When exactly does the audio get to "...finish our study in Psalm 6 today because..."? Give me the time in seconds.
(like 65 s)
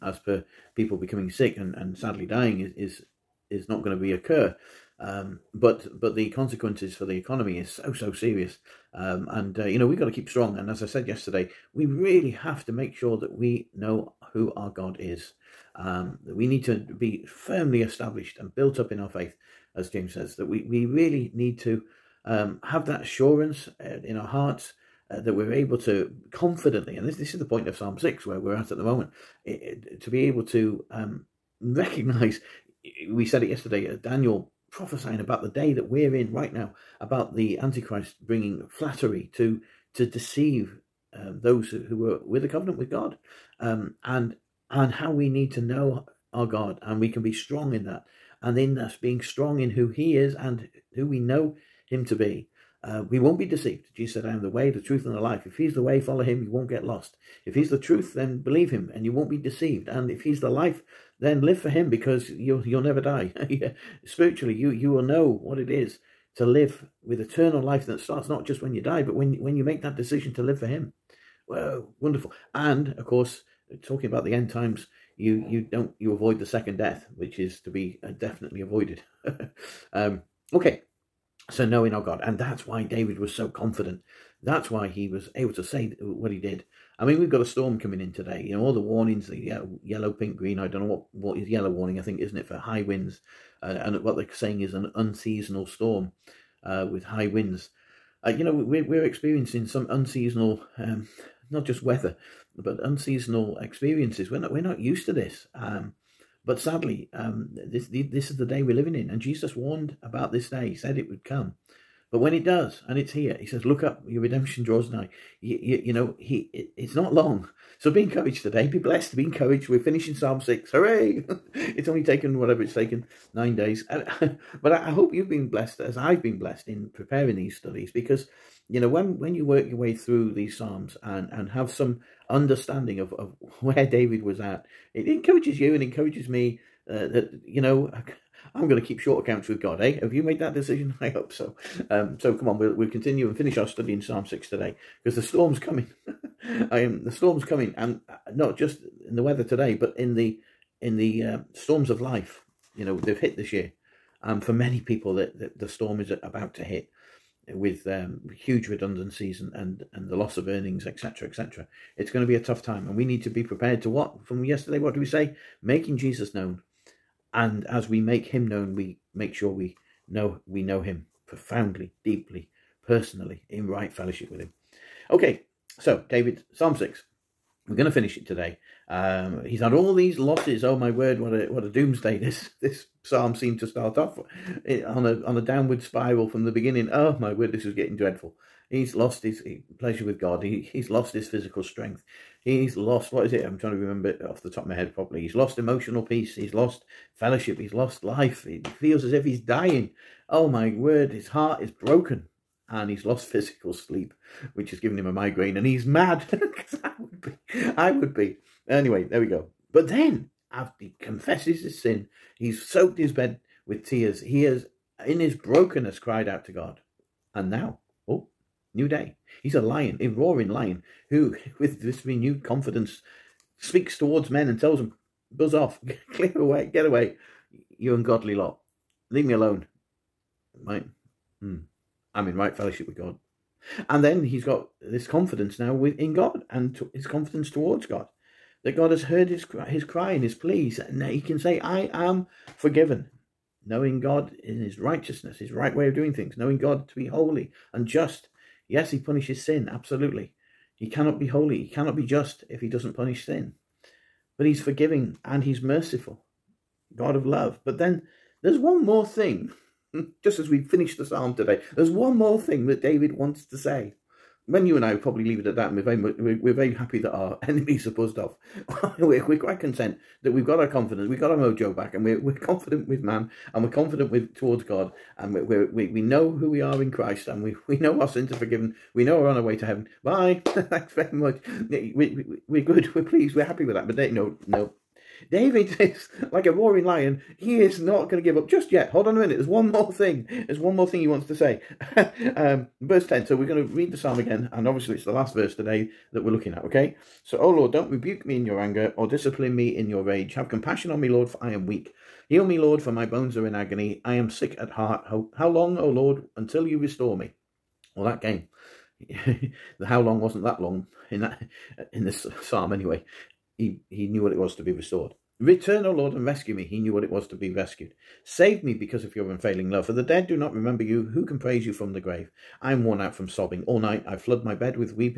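143 s.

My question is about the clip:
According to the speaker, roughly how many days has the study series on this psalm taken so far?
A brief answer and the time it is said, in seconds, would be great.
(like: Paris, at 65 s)
9 days, at 123 s.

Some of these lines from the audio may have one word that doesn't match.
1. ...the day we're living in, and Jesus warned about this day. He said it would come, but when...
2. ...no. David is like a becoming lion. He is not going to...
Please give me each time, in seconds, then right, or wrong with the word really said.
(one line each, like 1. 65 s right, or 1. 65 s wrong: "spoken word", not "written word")
1. 108 s right
2. 284 s wrong: "roaring", not "becoming".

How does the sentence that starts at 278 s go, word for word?
We know we're on our way to heaven.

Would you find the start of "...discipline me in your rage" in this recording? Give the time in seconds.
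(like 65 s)
299 s.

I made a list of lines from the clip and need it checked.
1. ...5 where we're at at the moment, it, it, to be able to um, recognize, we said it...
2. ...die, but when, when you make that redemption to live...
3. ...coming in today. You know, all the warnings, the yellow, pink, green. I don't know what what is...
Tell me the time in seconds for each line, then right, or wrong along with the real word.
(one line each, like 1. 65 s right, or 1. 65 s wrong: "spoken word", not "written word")
1. 27 s wrong: "6", not "5"
2. 68 s wrong: "decision", not "redemption"
3. 87 s right.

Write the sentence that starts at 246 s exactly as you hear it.
Knowing God to be holy and just.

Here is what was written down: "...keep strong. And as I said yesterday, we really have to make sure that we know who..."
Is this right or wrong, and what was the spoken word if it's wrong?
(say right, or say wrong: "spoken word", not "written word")
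right.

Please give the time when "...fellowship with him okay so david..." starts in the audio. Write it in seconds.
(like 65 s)
173 s.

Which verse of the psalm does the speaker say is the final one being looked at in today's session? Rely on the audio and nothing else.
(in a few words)
Verse 10.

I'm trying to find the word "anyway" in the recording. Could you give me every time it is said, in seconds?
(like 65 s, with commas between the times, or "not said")
208 s, 312 s.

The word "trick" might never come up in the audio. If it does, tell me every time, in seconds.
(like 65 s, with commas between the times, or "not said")
not said.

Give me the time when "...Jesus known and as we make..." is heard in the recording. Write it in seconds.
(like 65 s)
165 s.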